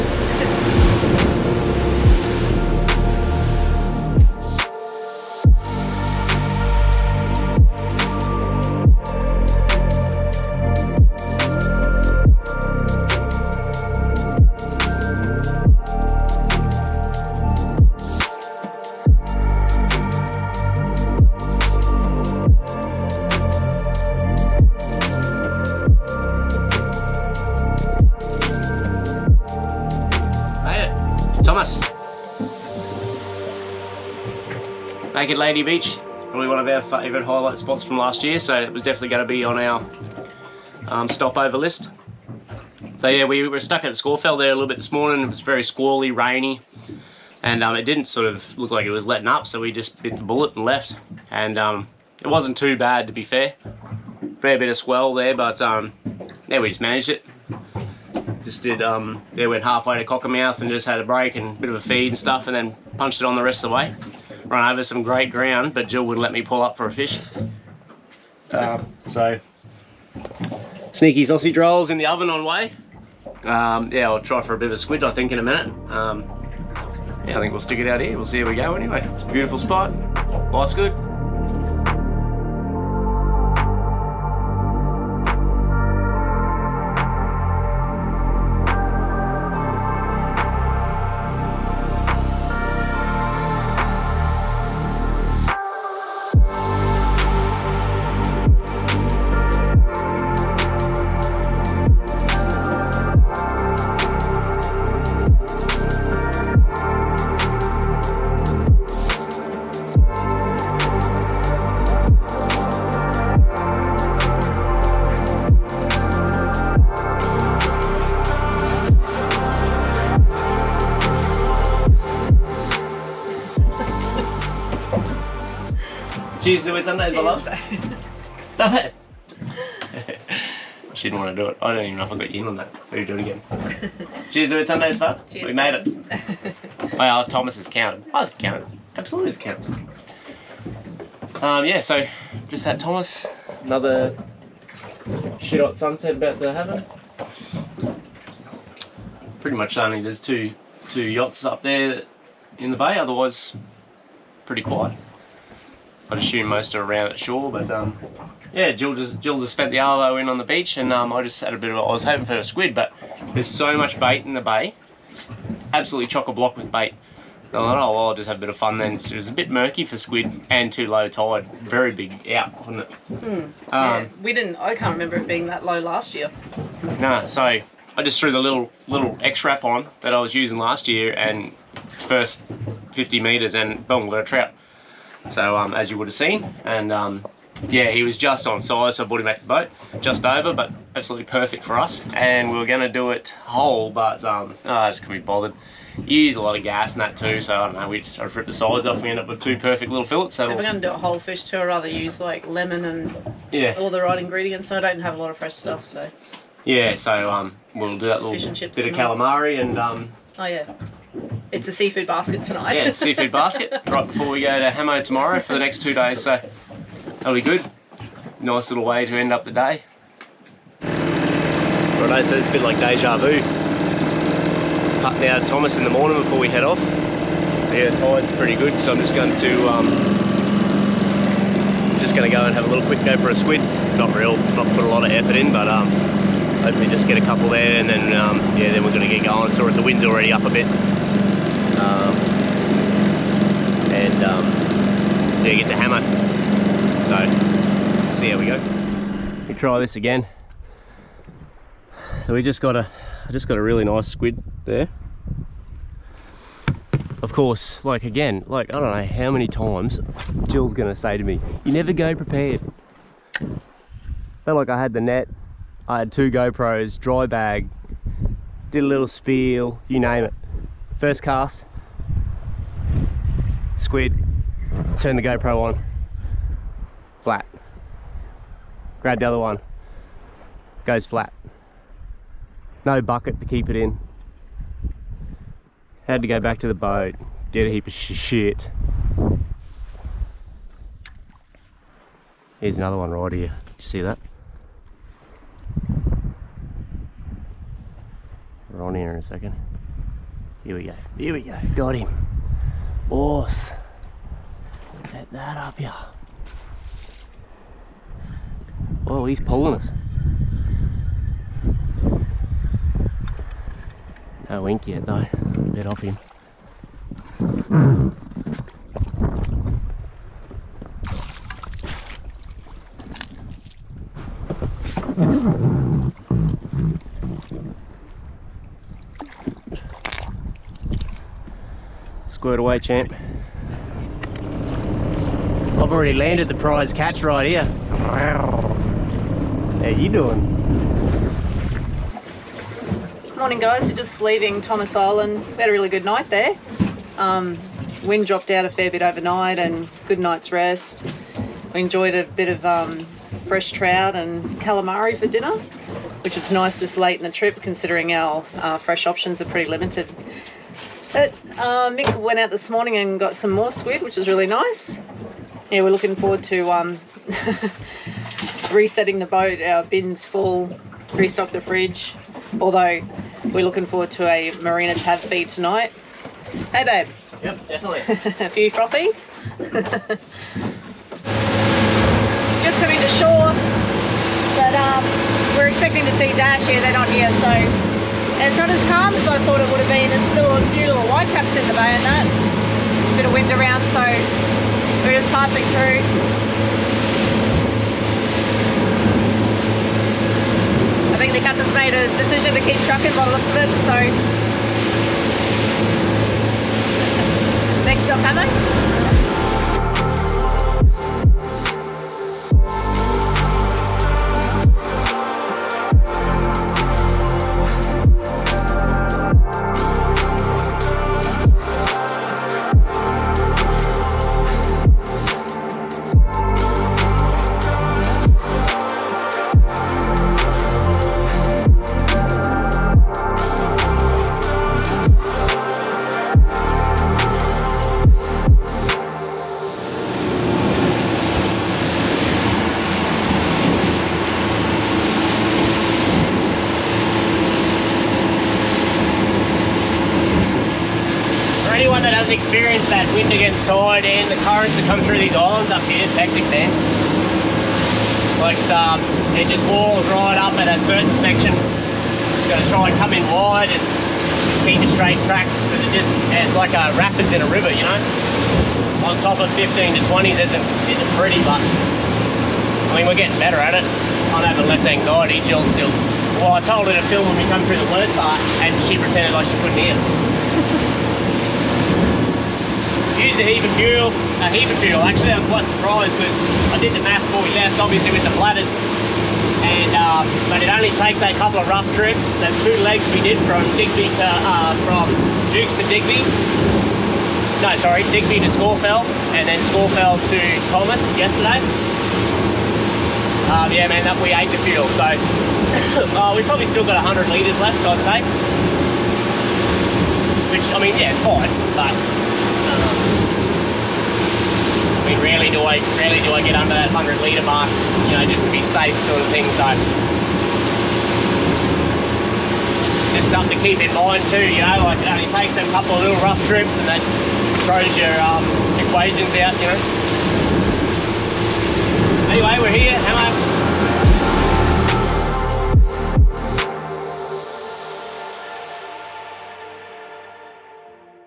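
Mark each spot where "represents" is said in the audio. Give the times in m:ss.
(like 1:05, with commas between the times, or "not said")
not said.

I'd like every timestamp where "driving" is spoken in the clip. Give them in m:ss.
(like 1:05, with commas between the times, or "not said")
not said.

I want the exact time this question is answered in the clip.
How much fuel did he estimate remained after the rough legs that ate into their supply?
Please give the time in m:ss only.
8:26.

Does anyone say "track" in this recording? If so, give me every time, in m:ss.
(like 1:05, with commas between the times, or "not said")
7:45.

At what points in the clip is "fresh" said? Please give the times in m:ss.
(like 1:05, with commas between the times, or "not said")
3:25, 5:53, 5:58.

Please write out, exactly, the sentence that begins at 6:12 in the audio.
Although we're looking forward to a marina tab feed tonight.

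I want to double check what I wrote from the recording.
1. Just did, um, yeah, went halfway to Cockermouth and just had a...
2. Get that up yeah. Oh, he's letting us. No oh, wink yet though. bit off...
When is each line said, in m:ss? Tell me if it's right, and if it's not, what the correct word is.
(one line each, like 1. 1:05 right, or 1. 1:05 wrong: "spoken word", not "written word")
1. 0:58 right
2. 5:05 wrong: "pulling", not "letting".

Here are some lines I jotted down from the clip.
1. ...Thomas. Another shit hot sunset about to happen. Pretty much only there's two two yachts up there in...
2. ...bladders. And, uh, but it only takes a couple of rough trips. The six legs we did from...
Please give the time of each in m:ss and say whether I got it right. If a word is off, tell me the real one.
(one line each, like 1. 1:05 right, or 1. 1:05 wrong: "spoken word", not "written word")
1. 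2:22 right
2. 8:08 wrong: "two", not "six".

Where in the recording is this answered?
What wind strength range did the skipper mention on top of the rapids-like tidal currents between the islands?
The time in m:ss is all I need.
7:49.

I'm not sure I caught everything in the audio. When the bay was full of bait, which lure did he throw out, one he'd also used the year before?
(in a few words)
X-Rap.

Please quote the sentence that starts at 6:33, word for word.
Bit of wind around, so we're just passing through.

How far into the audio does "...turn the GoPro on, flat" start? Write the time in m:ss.
4:34.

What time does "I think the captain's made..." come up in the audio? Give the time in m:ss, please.
6:41.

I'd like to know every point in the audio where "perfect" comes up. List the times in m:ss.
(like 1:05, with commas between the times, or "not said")
3:11, 3:19.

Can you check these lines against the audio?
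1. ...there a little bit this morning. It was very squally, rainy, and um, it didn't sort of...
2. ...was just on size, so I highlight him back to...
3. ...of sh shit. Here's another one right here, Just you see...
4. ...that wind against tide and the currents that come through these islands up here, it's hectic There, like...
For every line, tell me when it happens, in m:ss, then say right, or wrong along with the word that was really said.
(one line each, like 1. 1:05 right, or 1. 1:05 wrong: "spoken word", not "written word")
1. 0:44 right
2. 3:08 wrong: "brought", not "highlight"
3. 4:47 wrong: "Did", not "Just"
4. 7:32 right.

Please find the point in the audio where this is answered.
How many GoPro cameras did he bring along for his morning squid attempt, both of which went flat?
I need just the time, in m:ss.
4:26.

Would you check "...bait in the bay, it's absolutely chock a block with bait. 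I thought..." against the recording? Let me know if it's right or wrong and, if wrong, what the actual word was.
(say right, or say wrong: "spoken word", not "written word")
right.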